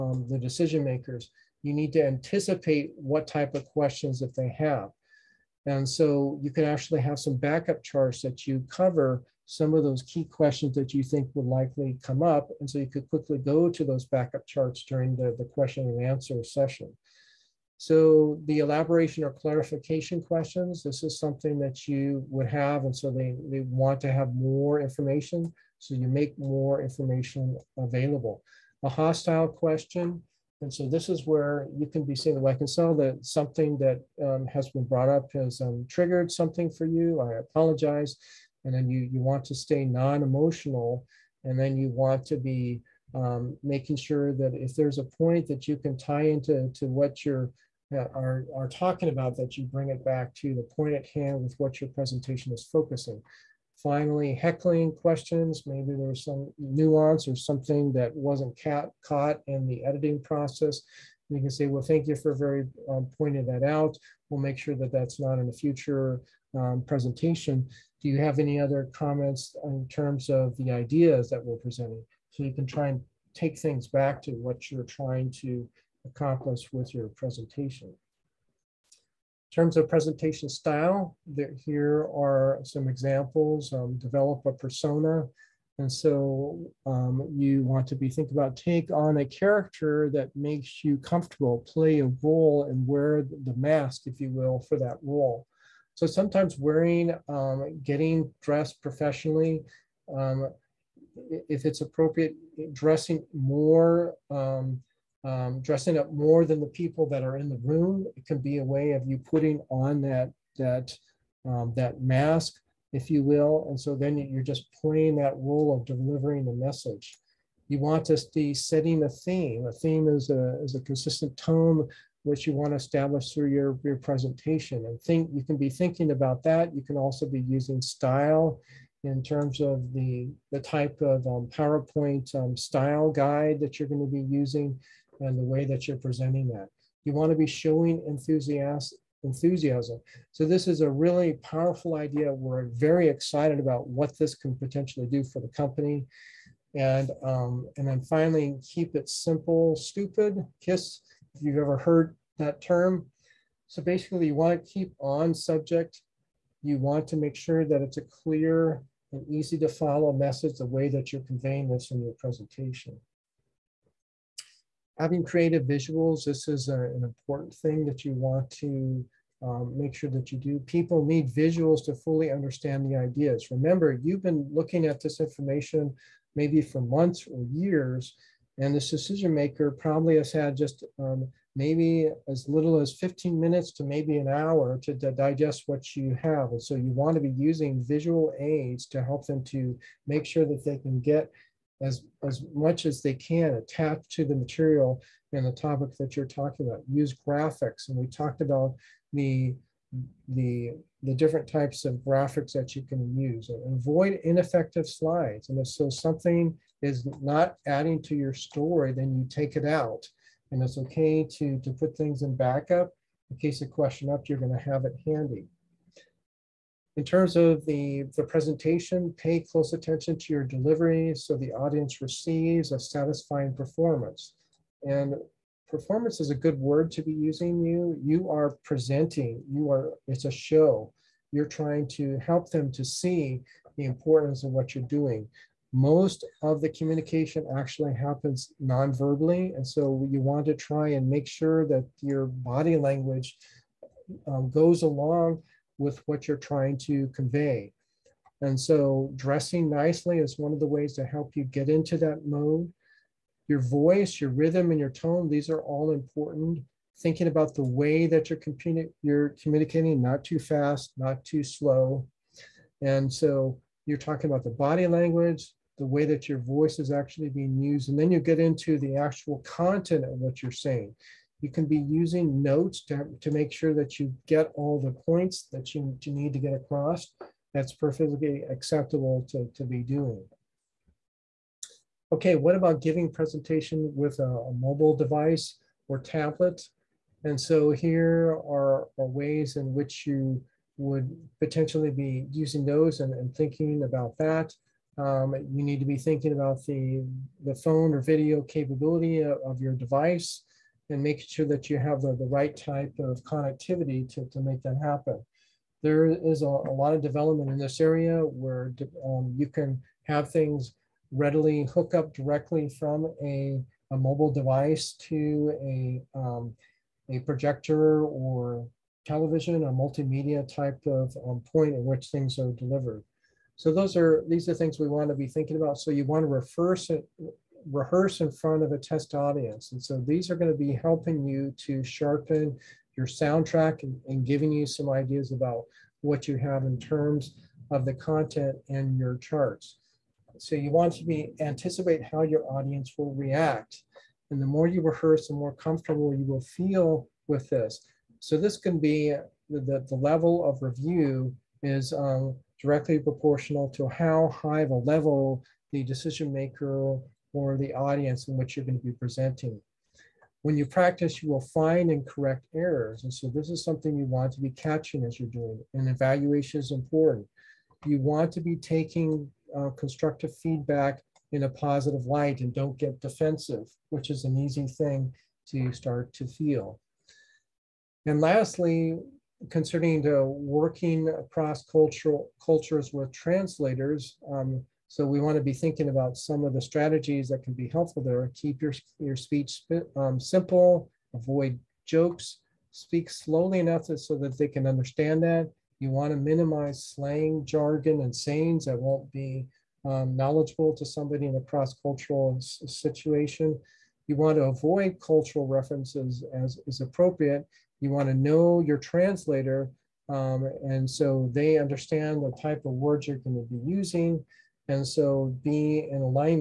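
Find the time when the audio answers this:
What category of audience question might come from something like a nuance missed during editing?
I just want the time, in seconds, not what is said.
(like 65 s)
54 s.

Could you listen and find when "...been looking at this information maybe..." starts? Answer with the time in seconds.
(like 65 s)
174 s.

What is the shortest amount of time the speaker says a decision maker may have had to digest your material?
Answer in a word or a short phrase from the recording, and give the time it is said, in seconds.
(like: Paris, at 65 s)
15 minutes, at 182 s.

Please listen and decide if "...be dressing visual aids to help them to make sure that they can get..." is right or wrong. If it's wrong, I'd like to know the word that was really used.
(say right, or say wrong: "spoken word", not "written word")
wrong: "using", not "dressing".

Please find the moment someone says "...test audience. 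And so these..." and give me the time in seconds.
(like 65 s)
328 s.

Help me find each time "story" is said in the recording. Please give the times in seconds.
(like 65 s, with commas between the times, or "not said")
208 s.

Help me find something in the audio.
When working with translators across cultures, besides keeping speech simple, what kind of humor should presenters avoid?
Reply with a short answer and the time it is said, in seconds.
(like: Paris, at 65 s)
Jokes, at 391 s.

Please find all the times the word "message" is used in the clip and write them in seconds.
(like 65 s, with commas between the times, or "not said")
116 s, 160 s.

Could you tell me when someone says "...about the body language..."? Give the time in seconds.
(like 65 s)
264 s.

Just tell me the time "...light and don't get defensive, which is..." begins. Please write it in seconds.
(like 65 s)
372 s.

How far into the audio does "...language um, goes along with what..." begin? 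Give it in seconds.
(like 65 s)
242 s.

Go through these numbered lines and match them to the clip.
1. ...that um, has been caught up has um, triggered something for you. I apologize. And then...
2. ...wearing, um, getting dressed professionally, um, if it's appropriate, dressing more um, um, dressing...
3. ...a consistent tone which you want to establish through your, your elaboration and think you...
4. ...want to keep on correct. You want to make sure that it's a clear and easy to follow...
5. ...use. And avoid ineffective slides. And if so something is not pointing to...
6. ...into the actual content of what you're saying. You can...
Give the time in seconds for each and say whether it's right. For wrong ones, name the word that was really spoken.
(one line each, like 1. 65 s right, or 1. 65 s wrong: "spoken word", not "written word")
1. 33 s wrong: "brought", not "caught"
2. 96 s right
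3. 120 s wrong: "presentation", not "elaboration"
4. 154 s wrong: "subject", not "correct"
5. 203 s wrong: "adding", not "pointing"
6. 268 s right.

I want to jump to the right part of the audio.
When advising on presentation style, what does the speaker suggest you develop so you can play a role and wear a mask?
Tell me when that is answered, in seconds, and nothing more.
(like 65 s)
84 s.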